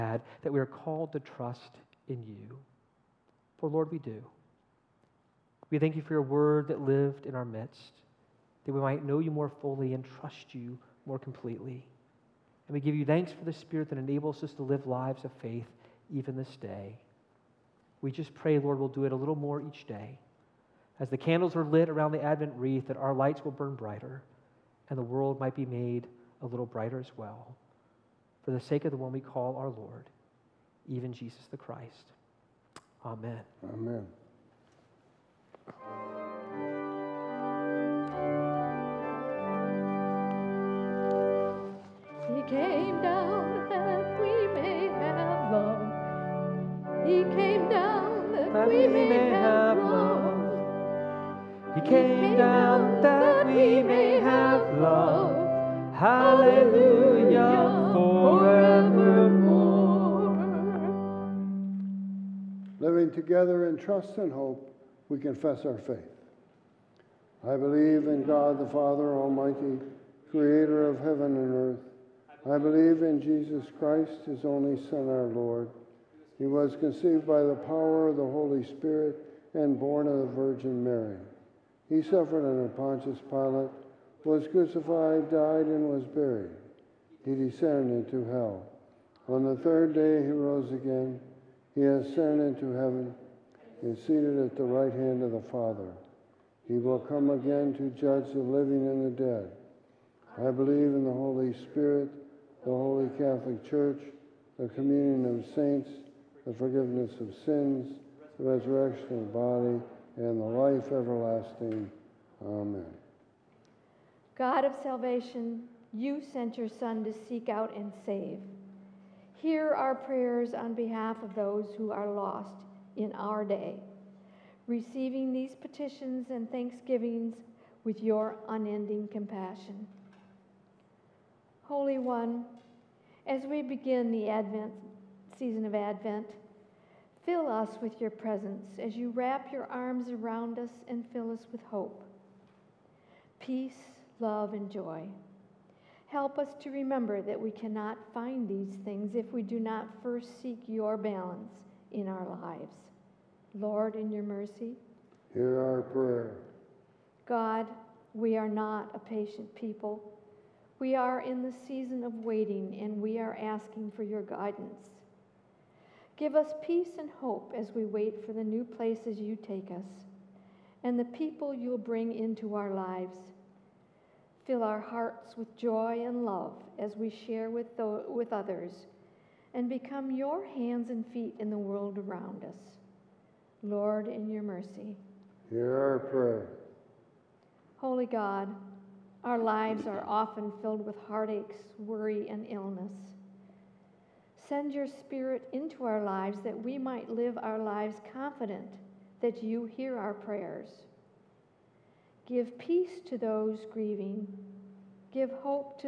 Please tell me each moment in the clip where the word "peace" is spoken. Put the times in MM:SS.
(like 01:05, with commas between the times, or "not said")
02:23, 02:46, 03:22.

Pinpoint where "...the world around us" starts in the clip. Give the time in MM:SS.
03:01.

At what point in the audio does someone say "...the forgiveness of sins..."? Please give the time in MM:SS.
01:46.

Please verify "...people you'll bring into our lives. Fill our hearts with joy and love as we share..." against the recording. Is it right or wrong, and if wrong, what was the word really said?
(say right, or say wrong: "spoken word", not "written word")
right.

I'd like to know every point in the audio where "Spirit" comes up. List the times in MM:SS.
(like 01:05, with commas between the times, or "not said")
00:13, 01:18, 01:41, 03:14.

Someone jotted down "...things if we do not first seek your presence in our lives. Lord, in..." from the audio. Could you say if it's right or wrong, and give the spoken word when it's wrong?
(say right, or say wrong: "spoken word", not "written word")
wrong: "balance", not "presence".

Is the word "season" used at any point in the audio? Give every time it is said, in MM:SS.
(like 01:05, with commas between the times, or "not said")
02:15, 02:41.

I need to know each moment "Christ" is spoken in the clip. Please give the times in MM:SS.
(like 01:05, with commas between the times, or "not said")
00:31, 01:13.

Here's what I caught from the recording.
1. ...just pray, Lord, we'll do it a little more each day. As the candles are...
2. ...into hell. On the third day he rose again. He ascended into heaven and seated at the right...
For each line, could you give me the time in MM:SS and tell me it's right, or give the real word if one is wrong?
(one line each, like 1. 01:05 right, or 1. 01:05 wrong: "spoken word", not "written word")
1. 00:18 right
2. 01:28 right.